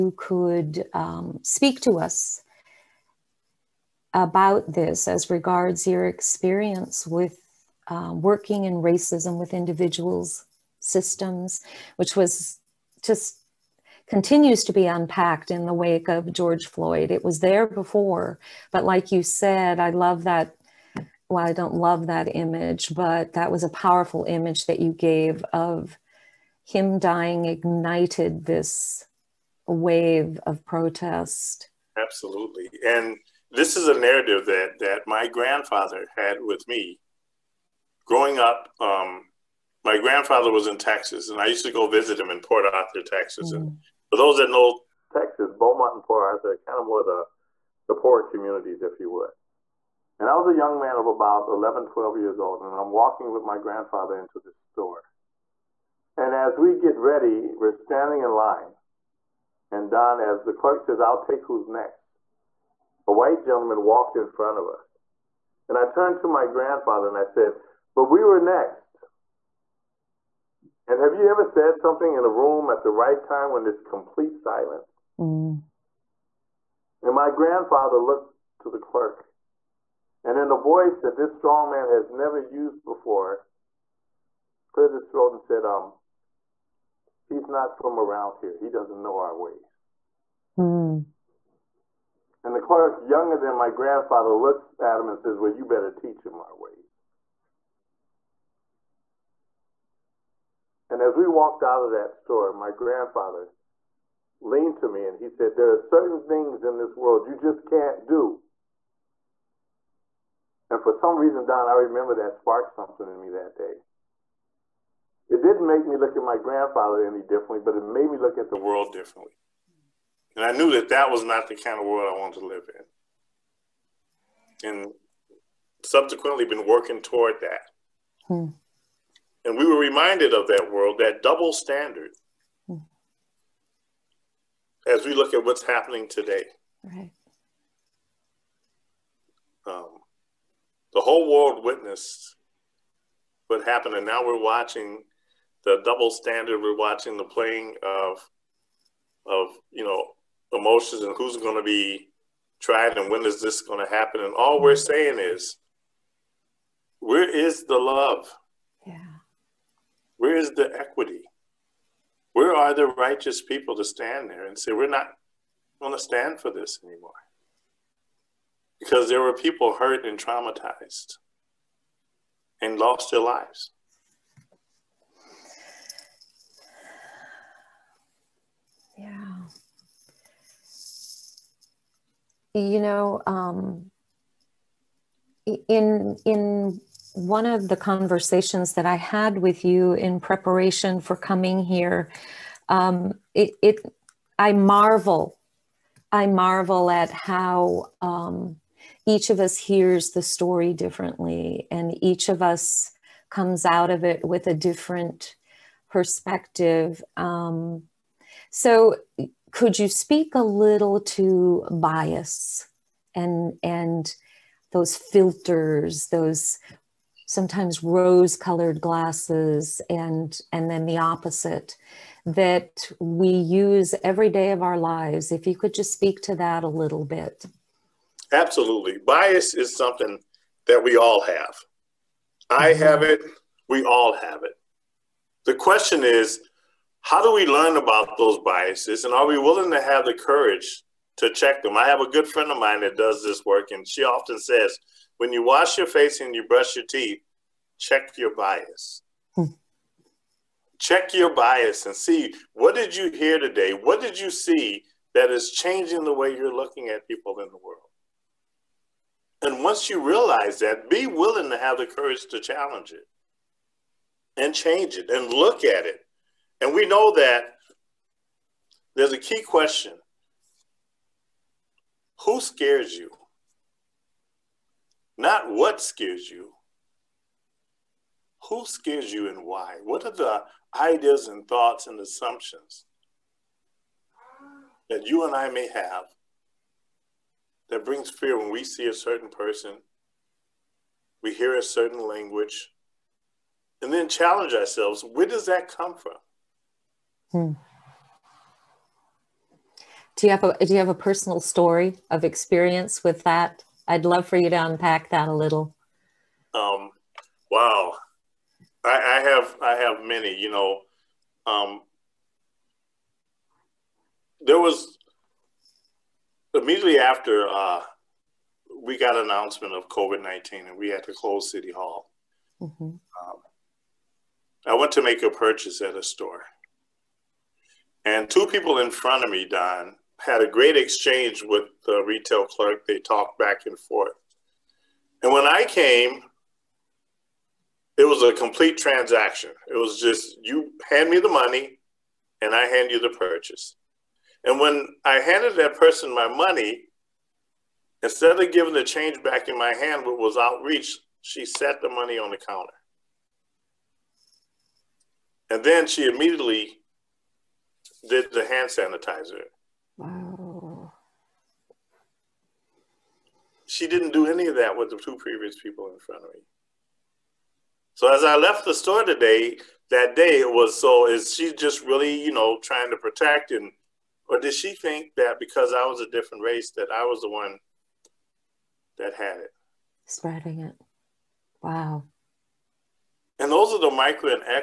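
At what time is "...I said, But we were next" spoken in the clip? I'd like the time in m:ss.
1:07.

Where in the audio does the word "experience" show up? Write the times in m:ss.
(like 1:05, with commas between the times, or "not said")
0:06, 5:02.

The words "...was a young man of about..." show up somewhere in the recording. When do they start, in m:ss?
0:50.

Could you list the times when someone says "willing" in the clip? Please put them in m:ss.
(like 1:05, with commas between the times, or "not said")
3:59, 4:21.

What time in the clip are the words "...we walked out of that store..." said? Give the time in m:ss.
1:41.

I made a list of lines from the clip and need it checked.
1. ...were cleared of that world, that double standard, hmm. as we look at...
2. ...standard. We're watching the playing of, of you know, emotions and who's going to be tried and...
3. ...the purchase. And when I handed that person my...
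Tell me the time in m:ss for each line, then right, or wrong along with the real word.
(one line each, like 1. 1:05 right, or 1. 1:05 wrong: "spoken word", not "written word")
1. 2:09 wrong: "reminded", not "cleared"
2. 2:26 right
3. 5:42 right.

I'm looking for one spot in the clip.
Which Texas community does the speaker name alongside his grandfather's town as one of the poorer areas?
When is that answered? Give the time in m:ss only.
0:45.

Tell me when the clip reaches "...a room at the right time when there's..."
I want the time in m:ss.
1:12.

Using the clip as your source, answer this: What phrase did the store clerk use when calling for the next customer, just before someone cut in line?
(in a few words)
I'll take who's next.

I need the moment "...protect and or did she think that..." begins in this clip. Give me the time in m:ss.
6:12.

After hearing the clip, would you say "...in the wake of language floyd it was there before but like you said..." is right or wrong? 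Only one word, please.
wrong.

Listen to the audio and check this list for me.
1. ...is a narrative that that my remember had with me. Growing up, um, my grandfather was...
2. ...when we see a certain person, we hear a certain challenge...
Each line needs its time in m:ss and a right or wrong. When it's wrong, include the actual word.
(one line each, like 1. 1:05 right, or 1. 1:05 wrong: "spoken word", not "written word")
1. 0:33 wrong: "grandfather", not "remember"
2. 4:48 wrong: "language", not "challenge".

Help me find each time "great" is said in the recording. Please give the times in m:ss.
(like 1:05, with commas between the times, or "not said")
5:30.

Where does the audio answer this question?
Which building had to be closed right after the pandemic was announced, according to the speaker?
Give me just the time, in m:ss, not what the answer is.
5:21.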